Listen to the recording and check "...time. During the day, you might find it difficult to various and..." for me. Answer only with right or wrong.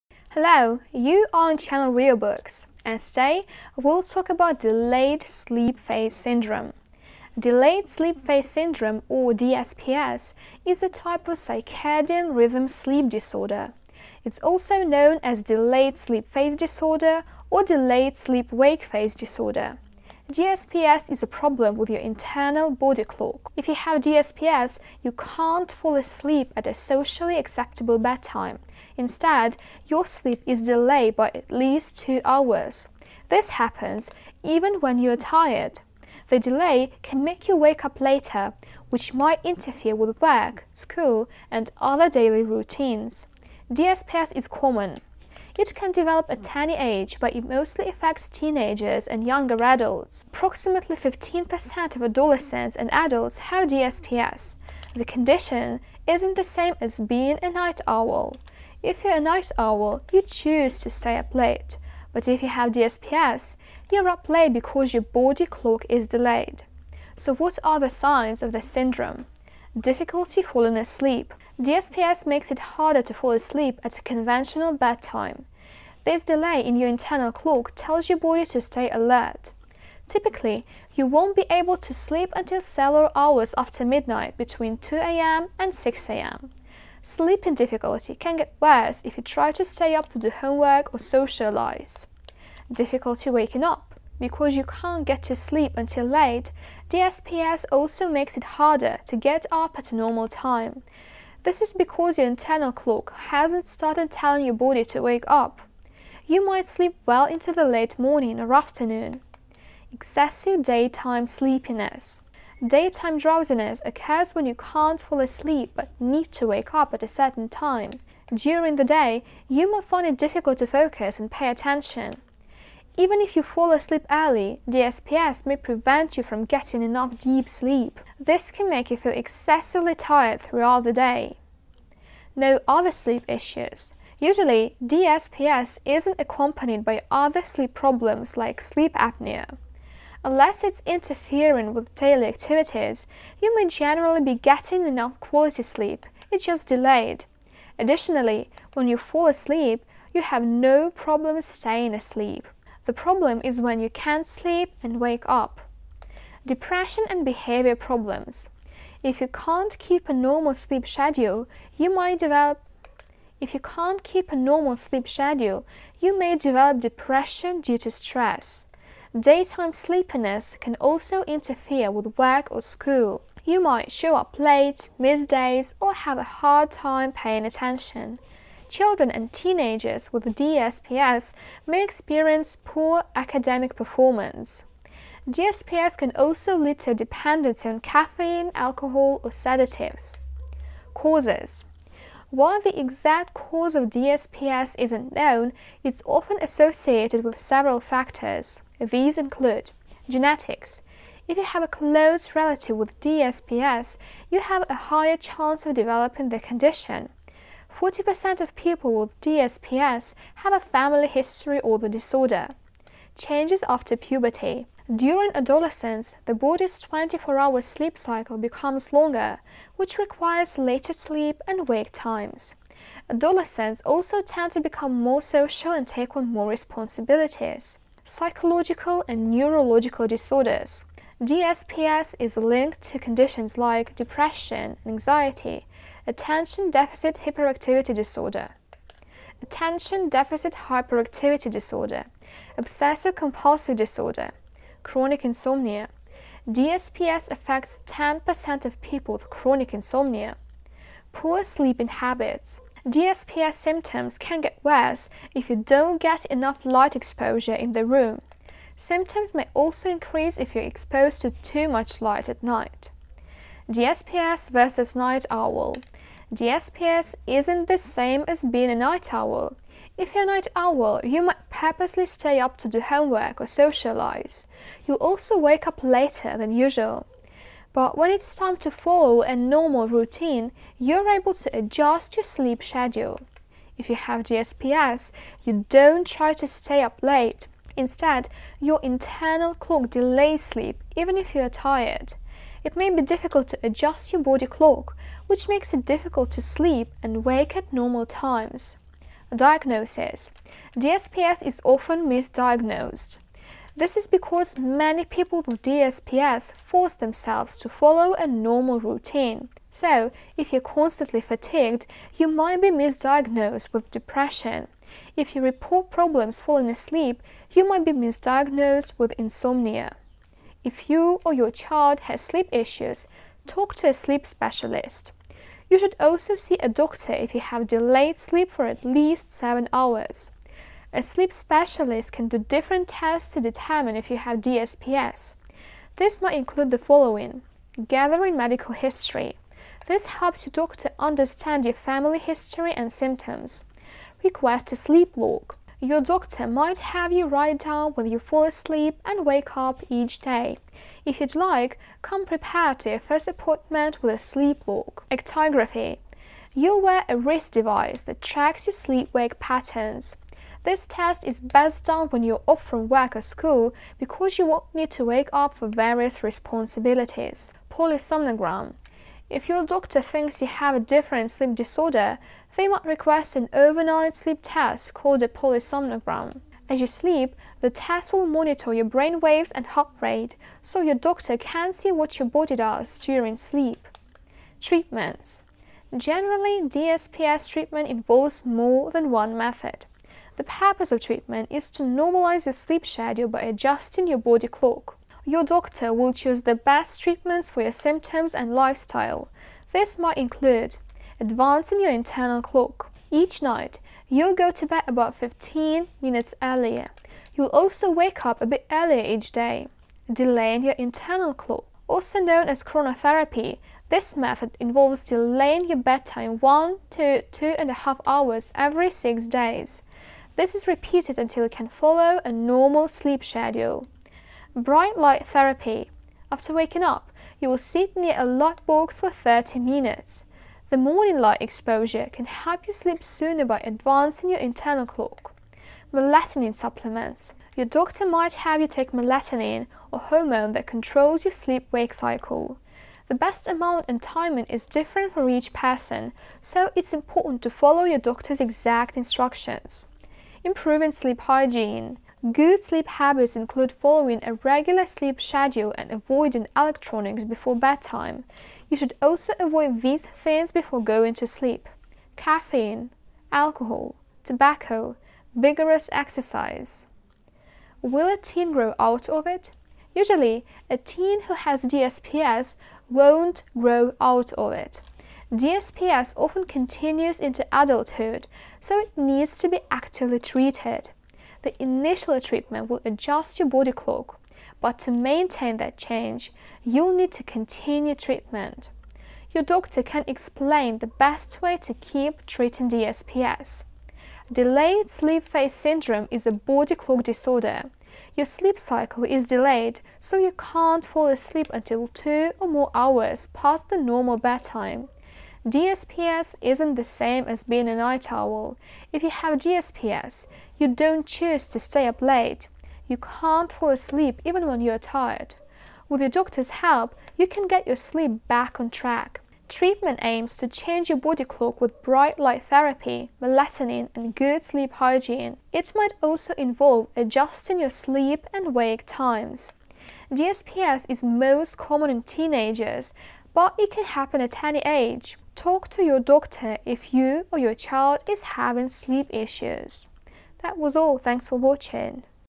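wrong.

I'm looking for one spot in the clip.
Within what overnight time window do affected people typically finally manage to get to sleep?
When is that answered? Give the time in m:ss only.
1:24.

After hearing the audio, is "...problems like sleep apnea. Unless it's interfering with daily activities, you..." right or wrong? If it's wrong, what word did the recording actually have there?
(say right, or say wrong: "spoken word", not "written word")
right.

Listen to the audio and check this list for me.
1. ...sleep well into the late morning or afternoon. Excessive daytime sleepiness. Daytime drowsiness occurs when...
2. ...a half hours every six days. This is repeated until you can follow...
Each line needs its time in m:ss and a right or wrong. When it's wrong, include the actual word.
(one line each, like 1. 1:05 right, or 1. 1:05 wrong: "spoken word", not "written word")
1. 1:46 right
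2. 6:57 right.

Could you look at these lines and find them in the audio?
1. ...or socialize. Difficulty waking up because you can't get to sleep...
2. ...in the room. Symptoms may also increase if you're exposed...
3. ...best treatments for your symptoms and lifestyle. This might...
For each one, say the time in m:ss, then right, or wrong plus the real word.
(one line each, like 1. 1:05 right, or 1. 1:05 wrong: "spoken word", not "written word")
1. 1:30 right
2. 4:17 right
3. 6:36 right.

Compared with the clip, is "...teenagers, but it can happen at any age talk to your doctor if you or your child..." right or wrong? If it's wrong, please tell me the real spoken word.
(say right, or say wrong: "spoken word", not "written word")
right.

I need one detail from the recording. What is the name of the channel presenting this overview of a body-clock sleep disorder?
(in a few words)
Real Books.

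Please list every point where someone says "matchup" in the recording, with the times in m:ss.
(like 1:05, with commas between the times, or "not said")
not said.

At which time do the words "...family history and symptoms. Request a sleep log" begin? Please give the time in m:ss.
5:41.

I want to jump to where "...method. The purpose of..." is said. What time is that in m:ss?
6:29.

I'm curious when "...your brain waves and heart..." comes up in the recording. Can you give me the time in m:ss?
6:18.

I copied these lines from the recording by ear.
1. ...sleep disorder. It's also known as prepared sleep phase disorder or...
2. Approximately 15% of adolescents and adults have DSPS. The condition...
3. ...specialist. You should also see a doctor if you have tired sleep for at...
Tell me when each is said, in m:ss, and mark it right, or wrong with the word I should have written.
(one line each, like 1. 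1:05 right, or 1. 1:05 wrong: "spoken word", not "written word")
1. 0:12 wrong: "delayed", not "prepared"
2. 0:50 right
3. 5:24 wrong: "delayed", not "tired".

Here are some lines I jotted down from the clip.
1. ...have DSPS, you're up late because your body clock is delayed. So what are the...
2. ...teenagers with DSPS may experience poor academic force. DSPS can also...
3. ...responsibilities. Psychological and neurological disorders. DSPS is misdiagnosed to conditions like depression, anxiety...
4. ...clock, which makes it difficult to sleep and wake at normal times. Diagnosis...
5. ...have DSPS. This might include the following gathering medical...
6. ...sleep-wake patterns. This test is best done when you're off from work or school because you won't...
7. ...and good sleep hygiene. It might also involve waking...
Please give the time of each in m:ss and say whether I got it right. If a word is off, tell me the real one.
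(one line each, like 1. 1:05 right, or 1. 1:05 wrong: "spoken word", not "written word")
1. 1:02 right
2. 2:59 wrong: "performance", not "force"
3. 3:46 wrong: "linked", not "misdiagnosed"
4. 4:54 right
5. 5:34 right
6. 5:58 right
7. 8:43 wrong: "adjusting", not "waking".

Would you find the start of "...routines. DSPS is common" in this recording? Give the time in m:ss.
0:42.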